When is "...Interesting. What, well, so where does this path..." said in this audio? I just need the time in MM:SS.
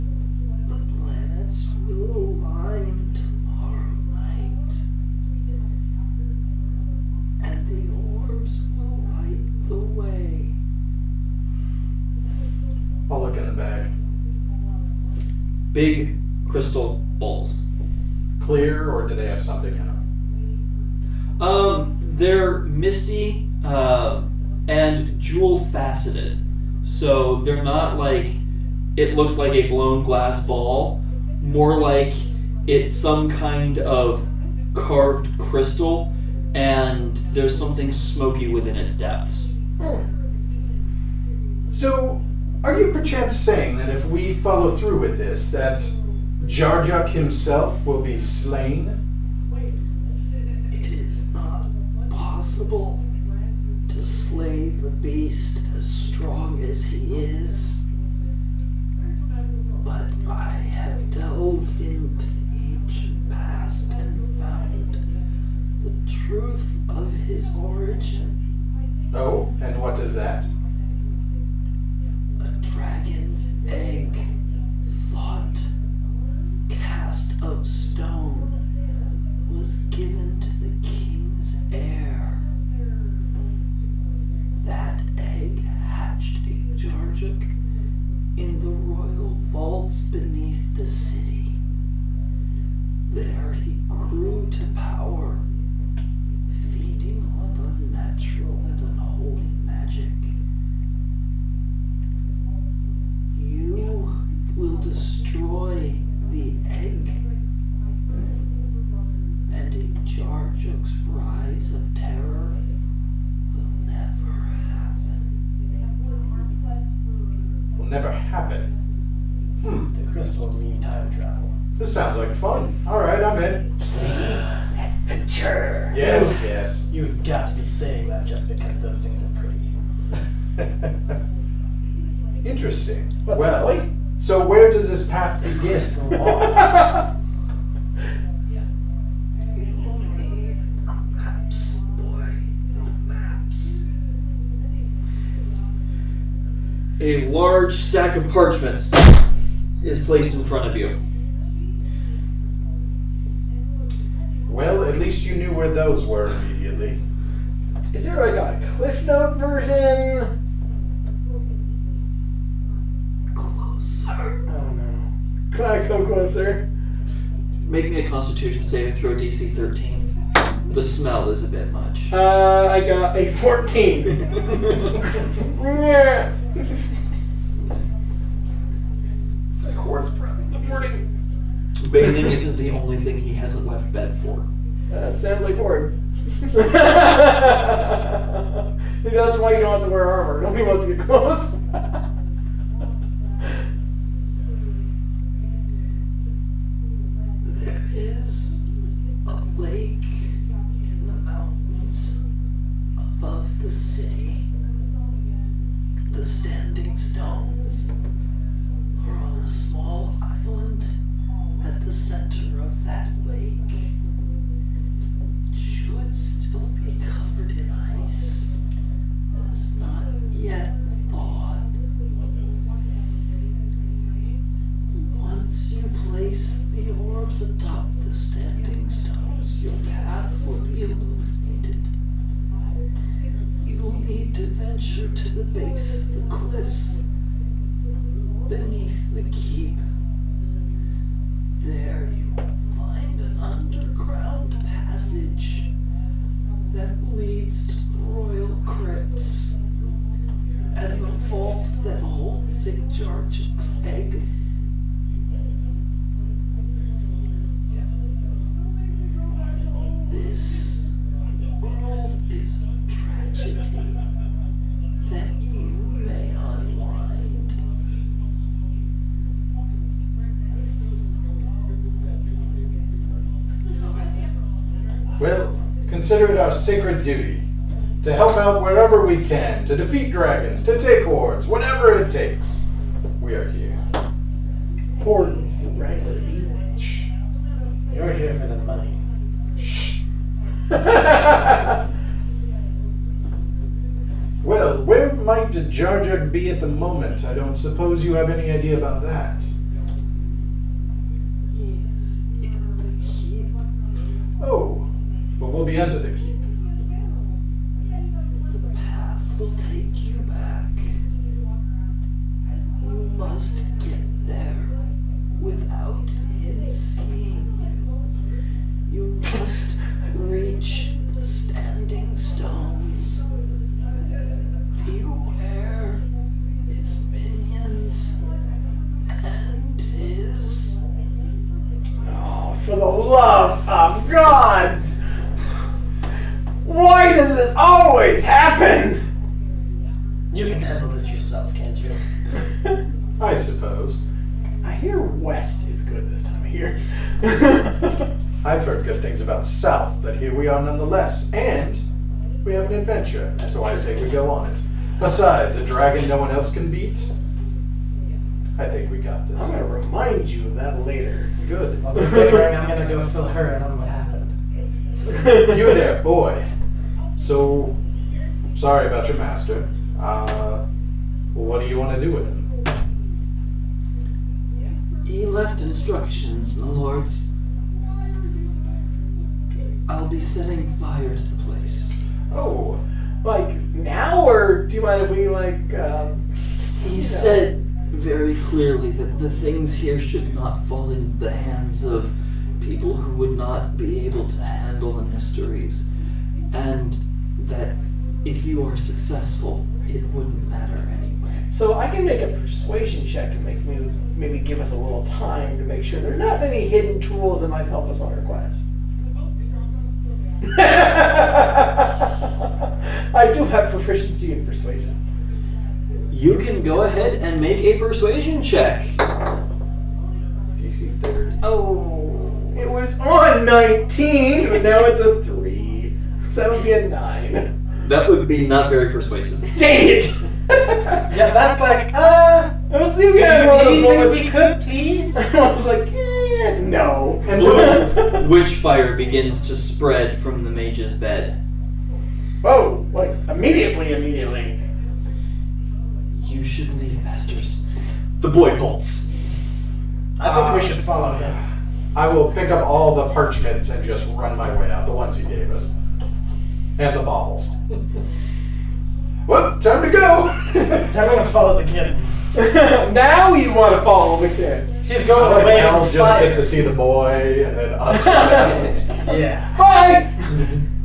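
02:12.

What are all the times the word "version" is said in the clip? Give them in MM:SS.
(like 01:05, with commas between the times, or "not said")
02:39.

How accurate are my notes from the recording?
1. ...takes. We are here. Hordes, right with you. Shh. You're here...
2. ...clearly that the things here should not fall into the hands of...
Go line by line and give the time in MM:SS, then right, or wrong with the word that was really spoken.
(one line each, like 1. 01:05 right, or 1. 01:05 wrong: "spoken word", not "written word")
1. 04:42 right
2. 06:28 right.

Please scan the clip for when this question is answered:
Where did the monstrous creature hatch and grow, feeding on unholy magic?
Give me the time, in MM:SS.
01:28.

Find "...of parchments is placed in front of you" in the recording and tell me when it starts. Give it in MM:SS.
02:28.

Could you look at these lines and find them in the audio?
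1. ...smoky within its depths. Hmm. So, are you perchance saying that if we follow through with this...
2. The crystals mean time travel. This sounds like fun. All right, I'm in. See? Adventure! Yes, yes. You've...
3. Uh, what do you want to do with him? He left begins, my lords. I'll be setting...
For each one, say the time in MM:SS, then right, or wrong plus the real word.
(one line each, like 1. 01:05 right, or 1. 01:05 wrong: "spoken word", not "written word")
1. 00:37 right
2. 01:59 right
3. 06:09 wrong: "instructions", not "begins".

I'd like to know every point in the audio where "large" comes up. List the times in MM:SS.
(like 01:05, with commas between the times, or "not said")
02:27.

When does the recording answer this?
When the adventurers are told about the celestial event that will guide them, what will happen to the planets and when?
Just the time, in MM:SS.
00:02.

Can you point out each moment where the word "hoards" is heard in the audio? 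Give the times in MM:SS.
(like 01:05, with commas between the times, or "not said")
04:41.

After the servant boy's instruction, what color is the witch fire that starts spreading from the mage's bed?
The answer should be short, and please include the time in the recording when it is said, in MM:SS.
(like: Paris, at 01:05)
Blue, at 07:17.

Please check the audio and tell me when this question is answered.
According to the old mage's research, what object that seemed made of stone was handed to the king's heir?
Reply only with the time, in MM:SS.
01:12.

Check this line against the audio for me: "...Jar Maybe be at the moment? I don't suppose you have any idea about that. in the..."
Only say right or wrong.
wrong.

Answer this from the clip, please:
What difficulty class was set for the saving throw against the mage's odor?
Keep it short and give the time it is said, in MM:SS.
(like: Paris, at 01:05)
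13, at 02:49.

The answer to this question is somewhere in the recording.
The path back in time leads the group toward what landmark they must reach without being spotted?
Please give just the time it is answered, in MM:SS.
05:21.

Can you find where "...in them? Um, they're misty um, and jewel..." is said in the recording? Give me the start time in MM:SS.
00:19.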